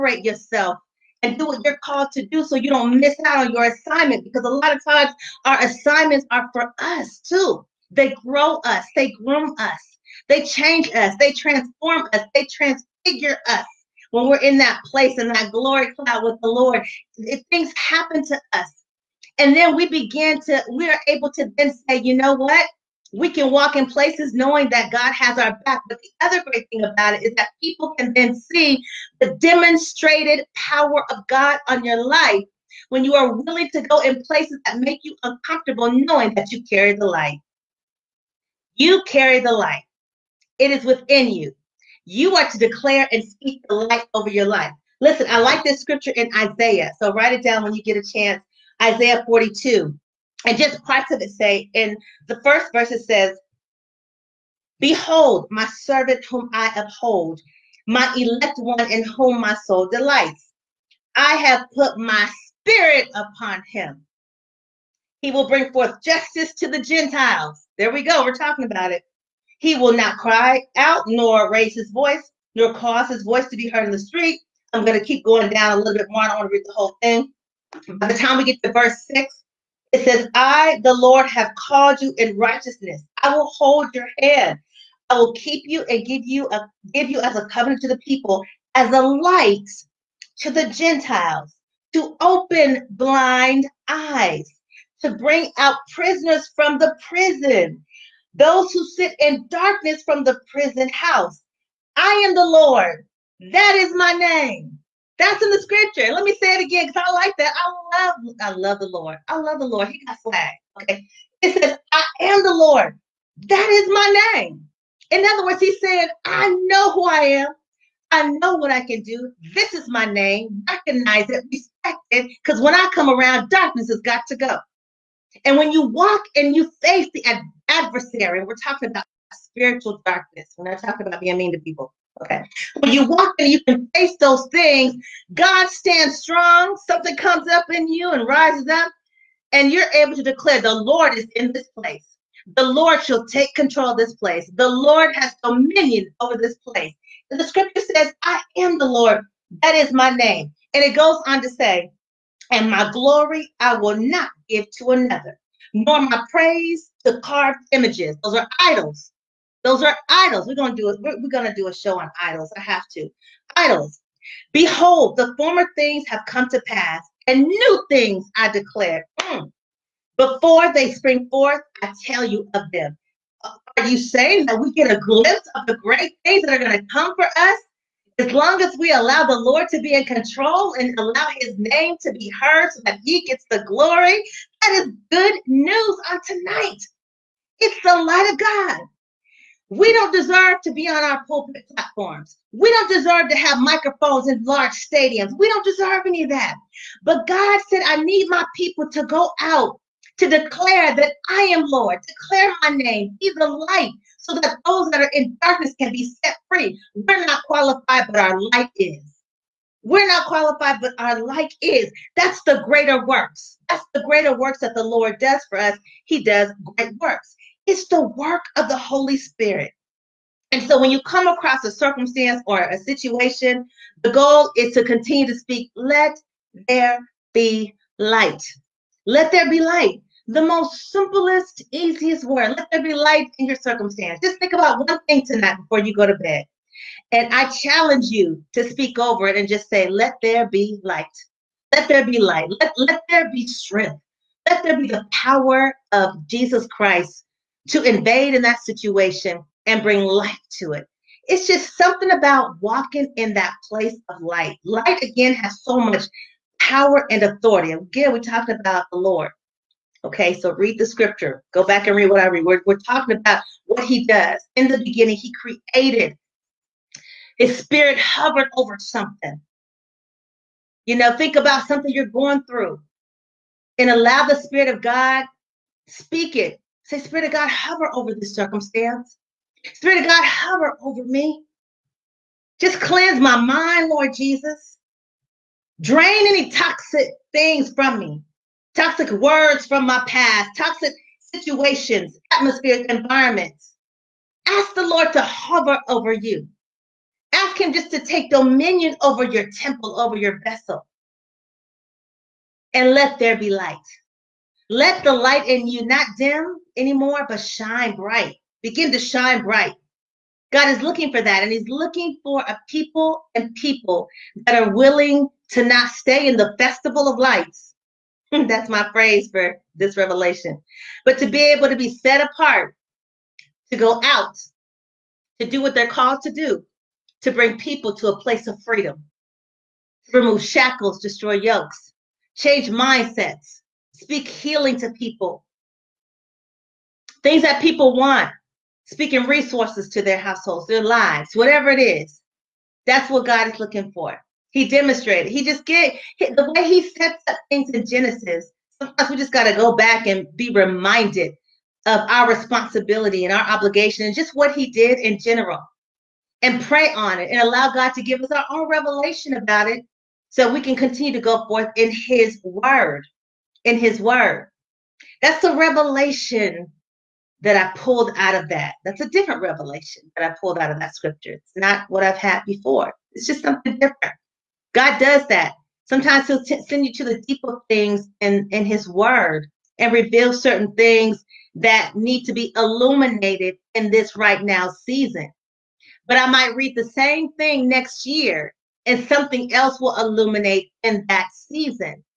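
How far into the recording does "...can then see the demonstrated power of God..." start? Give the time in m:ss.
0:27.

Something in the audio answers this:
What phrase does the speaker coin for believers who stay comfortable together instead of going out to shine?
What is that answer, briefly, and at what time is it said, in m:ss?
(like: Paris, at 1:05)
festival of lights, at 5:16.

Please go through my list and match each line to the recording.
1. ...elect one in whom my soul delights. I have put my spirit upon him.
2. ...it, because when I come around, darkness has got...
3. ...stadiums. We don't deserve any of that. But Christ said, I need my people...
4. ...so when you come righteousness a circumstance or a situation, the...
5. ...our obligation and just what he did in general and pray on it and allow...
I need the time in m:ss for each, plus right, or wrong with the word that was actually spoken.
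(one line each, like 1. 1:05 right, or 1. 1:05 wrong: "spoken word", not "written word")
1. 0:58 right
2. 2:02 right
3. 3:14 wrong: "God", not "Christ"
4. 3:40 wrong: "across", not "righteousness"
5. 5:53 right.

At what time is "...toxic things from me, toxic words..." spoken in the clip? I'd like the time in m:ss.
4:46.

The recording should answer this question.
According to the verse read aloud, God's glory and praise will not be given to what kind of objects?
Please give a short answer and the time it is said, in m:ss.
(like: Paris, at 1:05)
carved images, at 2:37.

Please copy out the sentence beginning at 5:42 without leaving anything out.
That's what God is looking for.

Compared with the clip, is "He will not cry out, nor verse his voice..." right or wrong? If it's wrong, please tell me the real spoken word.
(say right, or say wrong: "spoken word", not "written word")
wrong: "raise", not "verse".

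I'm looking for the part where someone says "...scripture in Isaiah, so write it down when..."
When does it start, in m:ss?
0:45.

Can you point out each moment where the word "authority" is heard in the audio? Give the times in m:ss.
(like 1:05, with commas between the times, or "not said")
4:17.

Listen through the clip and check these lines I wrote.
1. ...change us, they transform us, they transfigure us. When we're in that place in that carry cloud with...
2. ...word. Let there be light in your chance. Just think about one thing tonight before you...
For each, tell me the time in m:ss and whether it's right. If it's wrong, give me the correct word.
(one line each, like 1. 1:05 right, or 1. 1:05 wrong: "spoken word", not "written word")
1. 0:10 wrong: "glory", not "carry"
2. 3:52 wrong: "circumstance", not "chance".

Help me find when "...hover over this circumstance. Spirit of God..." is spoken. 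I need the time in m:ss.
4:37.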